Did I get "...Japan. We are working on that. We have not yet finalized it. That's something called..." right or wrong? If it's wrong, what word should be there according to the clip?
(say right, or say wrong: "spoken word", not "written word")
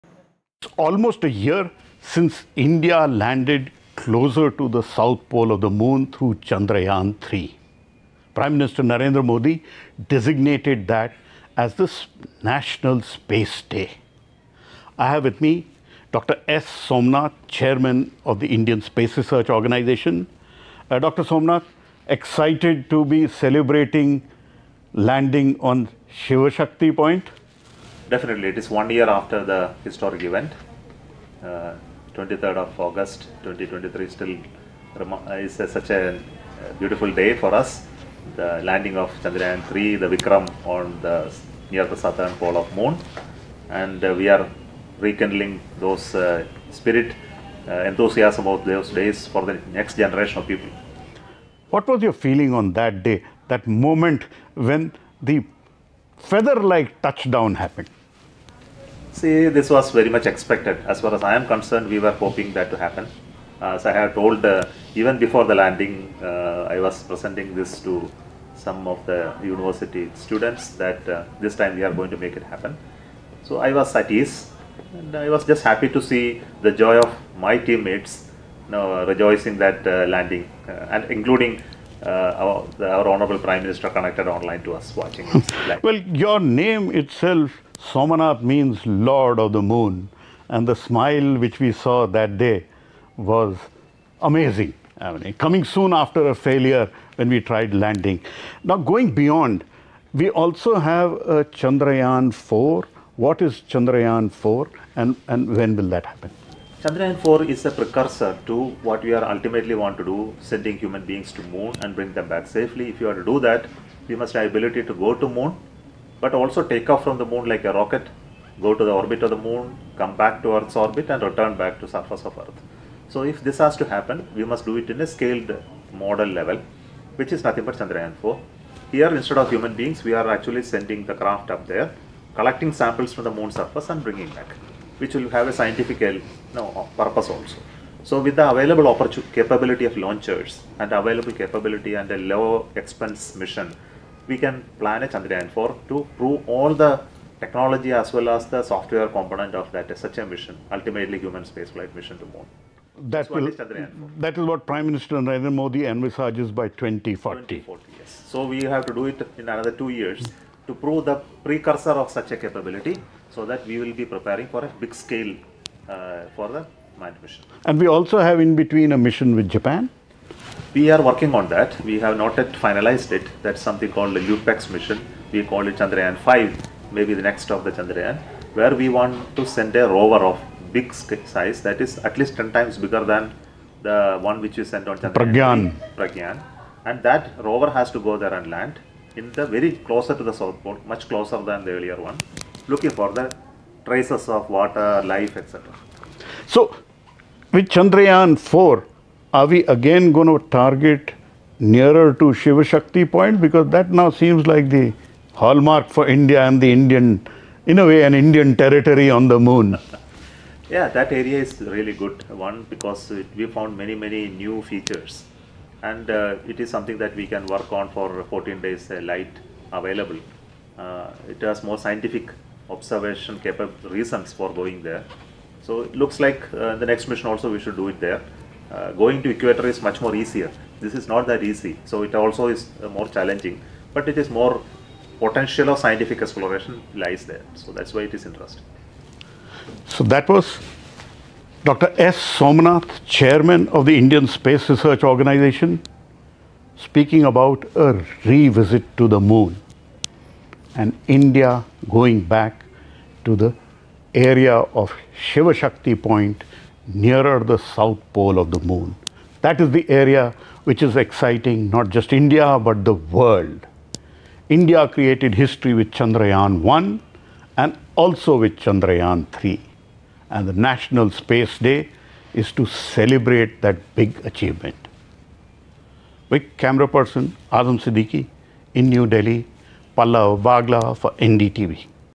right.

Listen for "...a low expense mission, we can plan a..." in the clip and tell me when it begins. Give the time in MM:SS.
02:22.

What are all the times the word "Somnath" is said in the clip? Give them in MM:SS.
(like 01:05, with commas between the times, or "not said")
00:16, 00:21, 04:02.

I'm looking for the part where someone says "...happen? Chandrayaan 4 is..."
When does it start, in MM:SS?
01:46.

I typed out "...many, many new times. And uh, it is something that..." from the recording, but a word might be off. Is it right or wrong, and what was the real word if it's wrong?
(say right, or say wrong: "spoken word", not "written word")
wrong: "features", not "times".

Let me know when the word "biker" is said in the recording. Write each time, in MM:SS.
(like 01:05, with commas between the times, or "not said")
not said.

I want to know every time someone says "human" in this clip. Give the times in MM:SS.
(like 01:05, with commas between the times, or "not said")
01:50, 02:09, 02:31.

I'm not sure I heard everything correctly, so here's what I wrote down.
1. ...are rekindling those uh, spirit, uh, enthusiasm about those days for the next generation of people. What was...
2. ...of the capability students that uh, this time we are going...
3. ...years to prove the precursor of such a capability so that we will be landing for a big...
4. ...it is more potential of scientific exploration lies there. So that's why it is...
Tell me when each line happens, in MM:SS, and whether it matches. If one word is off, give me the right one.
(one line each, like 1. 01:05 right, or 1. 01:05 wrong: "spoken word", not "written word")
1. 00:44 right
2. 01:08 wrong: "university", not "capability"
3. 02:39 wrong: "preparing", not "landing"
4. 03:54 right.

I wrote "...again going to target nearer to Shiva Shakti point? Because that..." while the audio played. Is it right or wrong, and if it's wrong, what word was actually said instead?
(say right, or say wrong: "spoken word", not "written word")
right.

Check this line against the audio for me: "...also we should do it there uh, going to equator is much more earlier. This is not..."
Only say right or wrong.
wrong.